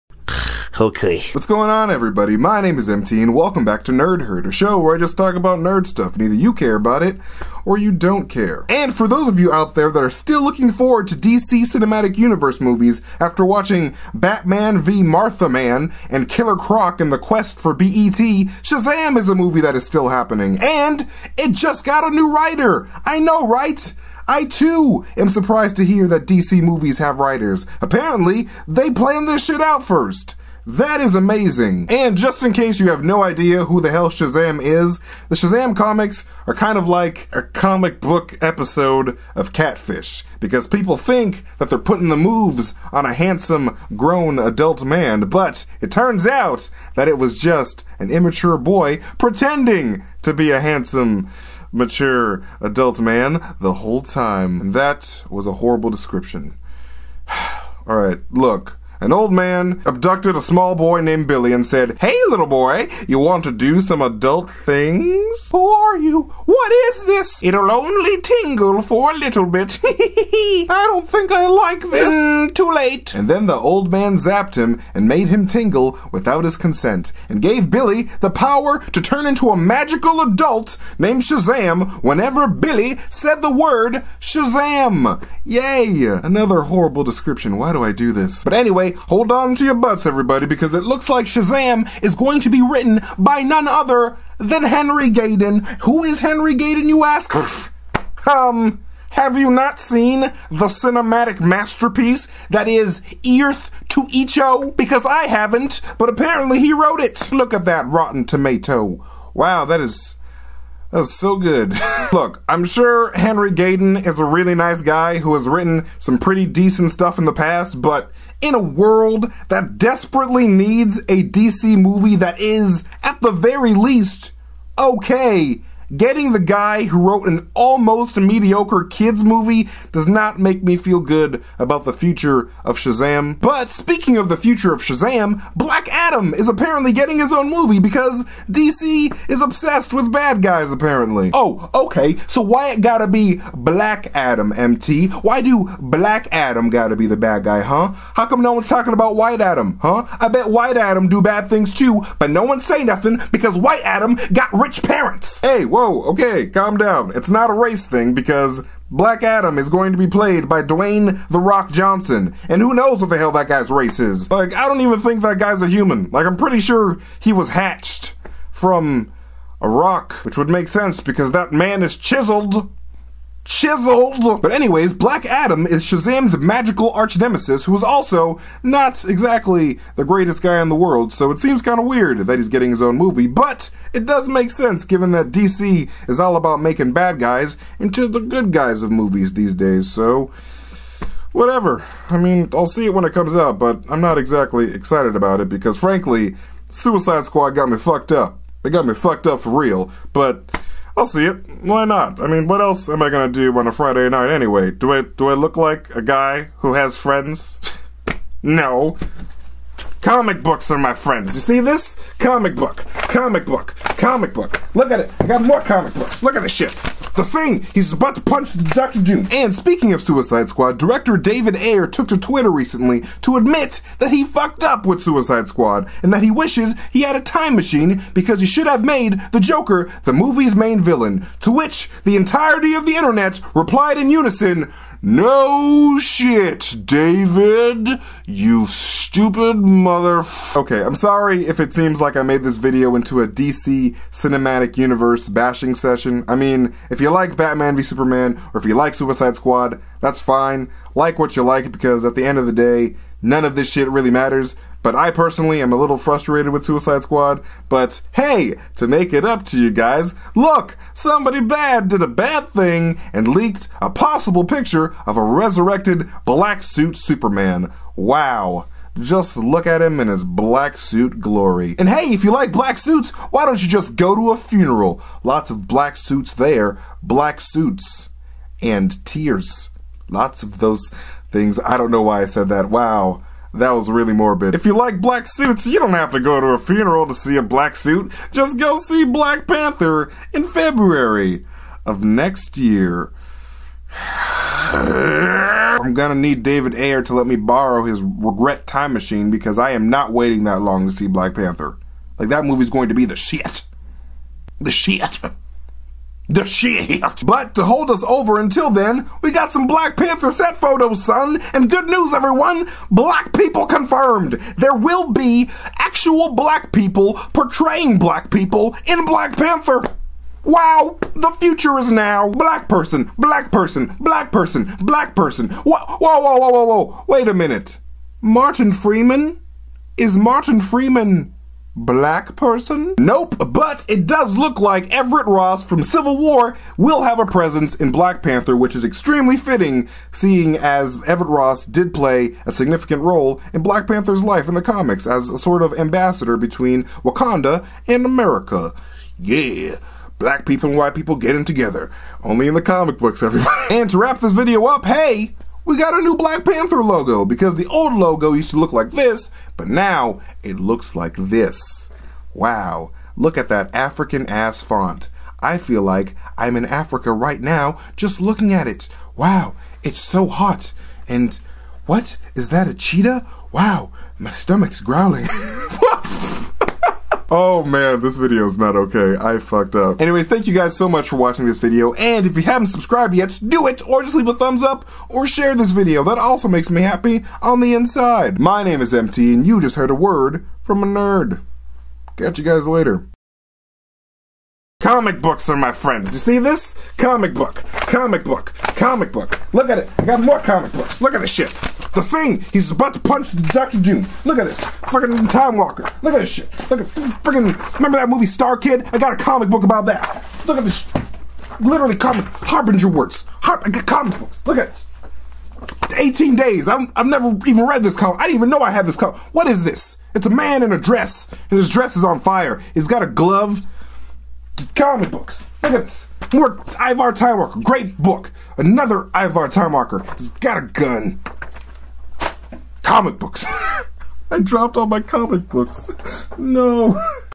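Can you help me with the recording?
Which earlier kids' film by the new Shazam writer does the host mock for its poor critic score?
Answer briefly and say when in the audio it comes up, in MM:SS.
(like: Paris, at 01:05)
Earth to Echo, at 01:43.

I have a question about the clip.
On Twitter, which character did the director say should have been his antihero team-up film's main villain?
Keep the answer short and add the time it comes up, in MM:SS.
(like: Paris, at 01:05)
The Joker, at 03:49.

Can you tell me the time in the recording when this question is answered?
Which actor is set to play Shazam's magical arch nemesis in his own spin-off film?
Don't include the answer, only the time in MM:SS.
02:40.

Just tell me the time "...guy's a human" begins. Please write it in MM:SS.
02:45.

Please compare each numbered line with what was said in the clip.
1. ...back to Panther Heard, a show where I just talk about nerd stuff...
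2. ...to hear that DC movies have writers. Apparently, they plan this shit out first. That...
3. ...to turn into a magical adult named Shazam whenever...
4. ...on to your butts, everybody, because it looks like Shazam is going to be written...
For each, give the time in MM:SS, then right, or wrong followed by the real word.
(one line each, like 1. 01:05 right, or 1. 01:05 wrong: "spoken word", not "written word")
1. 00:03 wrong: "Nerd", not "Panther"
2. 00:25 right
3. 01:18 right
4. 01:29 right.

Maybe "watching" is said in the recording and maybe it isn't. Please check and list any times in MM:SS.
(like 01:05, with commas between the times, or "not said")
00:13, 06:21.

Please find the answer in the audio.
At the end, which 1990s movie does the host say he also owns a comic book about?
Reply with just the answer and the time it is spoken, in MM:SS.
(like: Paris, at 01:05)
Star Kid, at 06:48.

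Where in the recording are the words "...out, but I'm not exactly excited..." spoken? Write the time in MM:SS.
03:13.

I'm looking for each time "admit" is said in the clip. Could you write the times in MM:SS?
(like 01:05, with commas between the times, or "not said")
03:43.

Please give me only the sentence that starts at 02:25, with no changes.
Why do Black Adam gotta be the bad guy, huh?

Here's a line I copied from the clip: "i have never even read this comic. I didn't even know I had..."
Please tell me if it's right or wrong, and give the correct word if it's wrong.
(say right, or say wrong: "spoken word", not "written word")
right.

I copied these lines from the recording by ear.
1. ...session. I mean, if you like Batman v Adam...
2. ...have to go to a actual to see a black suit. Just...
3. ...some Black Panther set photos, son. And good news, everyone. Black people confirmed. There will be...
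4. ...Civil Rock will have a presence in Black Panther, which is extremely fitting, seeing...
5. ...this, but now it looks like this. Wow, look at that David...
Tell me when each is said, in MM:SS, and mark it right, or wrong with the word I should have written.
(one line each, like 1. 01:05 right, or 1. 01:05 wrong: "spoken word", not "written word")
1. 04:05 wrong: "Superman", not "Adam"
2. 04:45 wrong: "funeral", not "actual"
3. 05:09 right
4. 05:35 wrong: "War", not "Rock"
5. 05:58 wrong: "African", not "David".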